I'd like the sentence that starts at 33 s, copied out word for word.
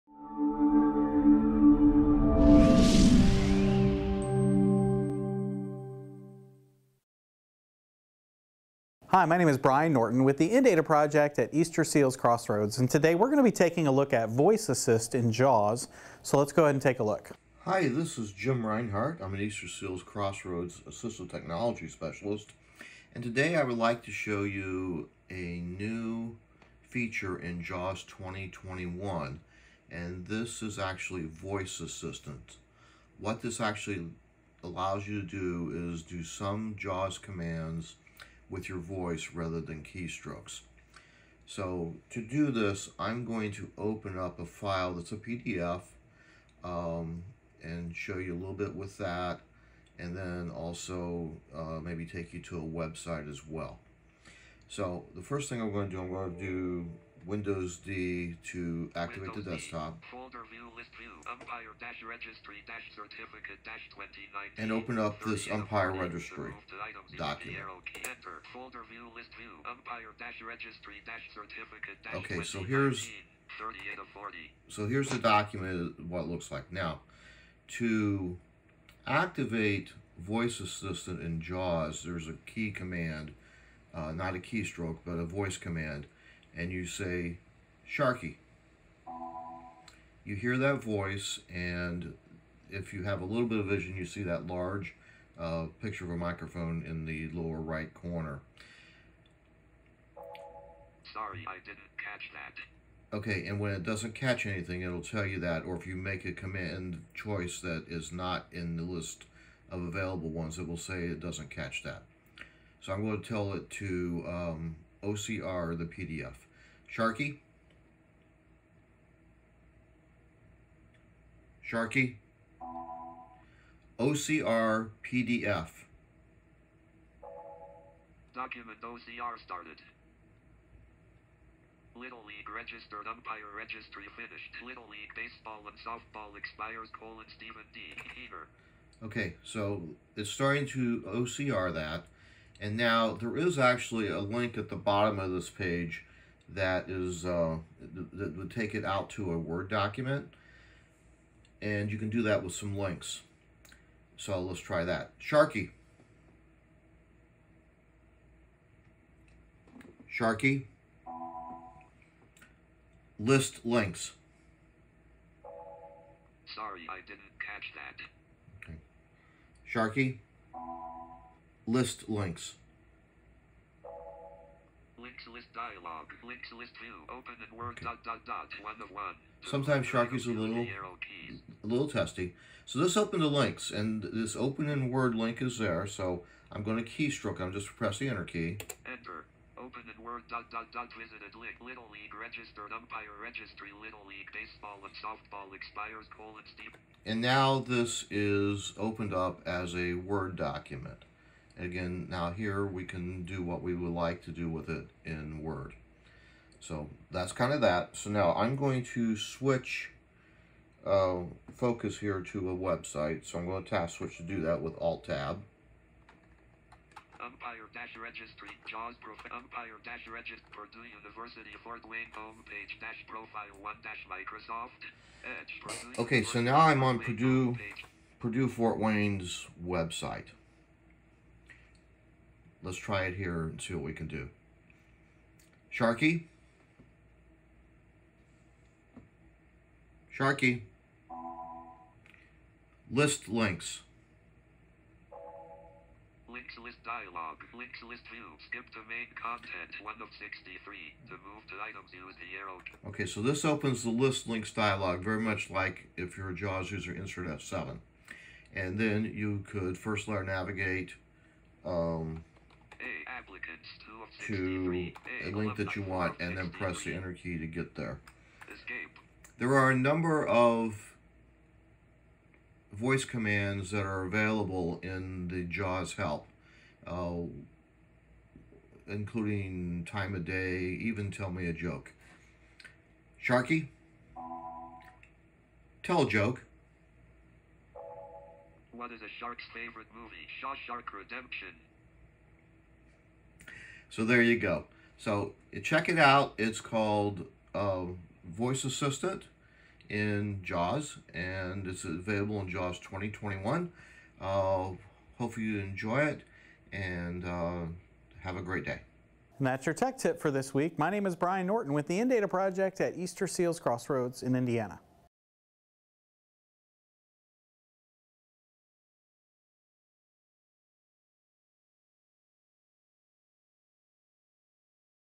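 What this actually allows you to do is do some JAWS commands with your voice rather than keystrokes.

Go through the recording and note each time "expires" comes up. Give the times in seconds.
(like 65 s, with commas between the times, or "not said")
136 s, 195 s.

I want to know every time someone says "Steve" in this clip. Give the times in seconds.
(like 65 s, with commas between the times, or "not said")
196 s.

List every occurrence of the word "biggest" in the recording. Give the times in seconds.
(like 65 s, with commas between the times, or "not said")
not said.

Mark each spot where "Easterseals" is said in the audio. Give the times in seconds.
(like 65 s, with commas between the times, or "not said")
11 s, 19 s, 312 s.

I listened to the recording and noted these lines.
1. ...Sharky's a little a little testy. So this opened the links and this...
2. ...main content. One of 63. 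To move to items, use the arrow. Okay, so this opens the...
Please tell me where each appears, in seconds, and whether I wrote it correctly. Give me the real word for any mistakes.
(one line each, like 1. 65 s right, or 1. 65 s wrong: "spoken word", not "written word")
1. 179 s right
2. 248 s right.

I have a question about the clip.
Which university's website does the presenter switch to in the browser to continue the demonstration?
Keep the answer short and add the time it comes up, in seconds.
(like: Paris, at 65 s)
Purdue University Fort Wayne, at 220 s.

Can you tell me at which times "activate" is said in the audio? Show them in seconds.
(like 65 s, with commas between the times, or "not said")
58 s, 79 s.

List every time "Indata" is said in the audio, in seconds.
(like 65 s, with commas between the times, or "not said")
10 s, 311 s.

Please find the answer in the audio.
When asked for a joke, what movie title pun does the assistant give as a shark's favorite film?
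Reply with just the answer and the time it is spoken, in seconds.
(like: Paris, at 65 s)
Shawshark Redemption, at 290 s.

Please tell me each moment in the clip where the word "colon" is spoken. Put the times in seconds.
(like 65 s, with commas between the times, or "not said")
136 s, 196 s.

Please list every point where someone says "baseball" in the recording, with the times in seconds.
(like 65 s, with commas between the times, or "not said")
135 s, 194 s.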